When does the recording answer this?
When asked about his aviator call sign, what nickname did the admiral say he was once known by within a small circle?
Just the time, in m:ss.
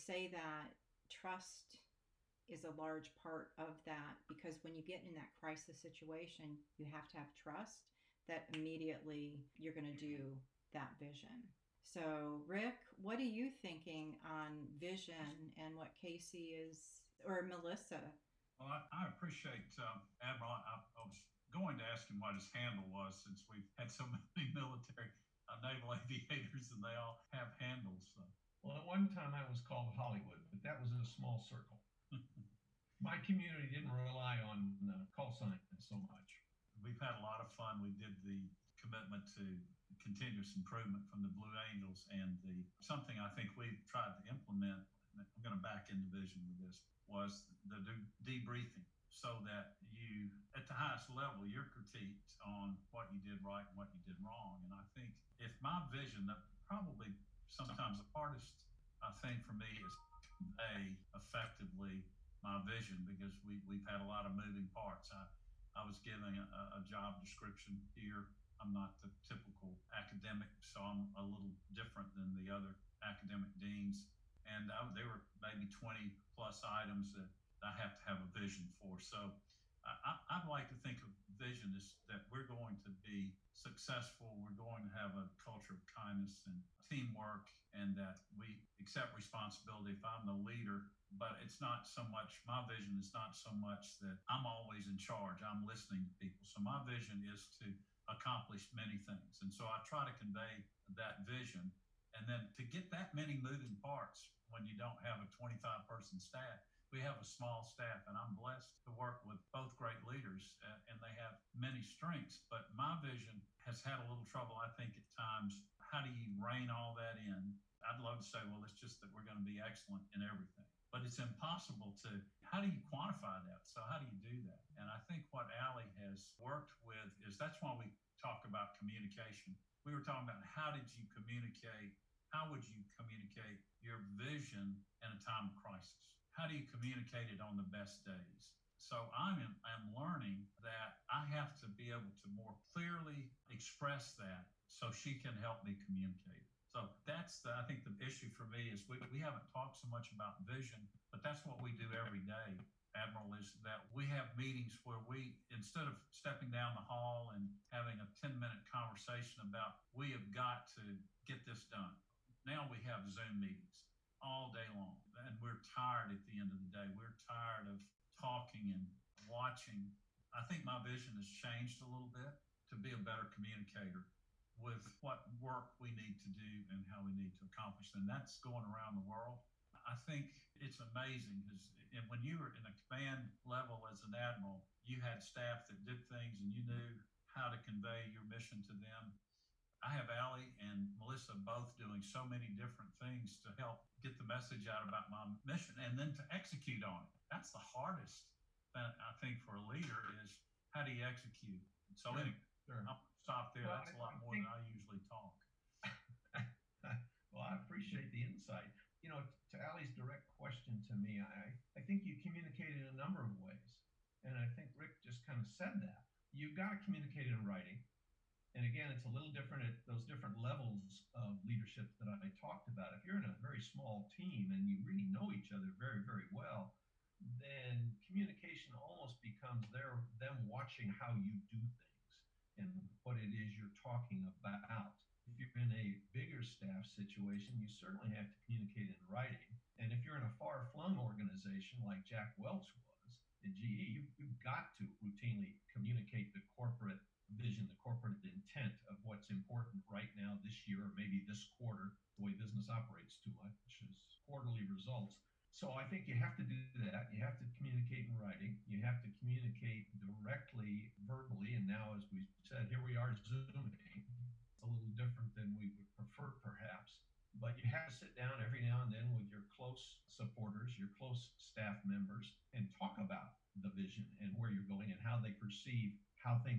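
0:29.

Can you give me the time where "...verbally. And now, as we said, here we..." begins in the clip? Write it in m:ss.
4:21.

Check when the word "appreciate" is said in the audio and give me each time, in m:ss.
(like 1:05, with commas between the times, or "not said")
0:19, 3:27.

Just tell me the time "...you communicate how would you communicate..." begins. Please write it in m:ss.
2:10.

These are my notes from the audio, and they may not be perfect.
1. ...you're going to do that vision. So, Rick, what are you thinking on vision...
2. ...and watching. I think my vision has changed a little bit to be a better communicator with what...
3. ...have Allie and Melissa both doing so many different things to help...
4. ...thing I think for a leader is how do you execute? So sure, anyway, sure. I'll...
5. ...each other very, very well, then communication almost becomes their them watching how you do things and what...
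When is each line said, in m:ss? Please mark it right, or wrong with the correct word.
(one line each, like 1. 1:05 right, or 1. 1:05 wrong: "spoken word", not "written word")
1. 0:09 right
2. 2:48 right
3. 3:09 right
4. 3:18 right
5. 3:45 right.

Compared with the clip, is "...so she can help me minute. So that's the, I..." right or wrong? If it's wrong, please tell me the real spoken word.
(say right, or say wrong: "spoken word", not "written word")
wrong: "communicate", not "minute".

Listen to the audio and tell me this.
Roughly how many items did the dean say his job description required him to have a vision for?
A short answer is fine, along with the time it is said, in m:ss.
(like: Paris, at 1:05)
20 plus, at 1:15.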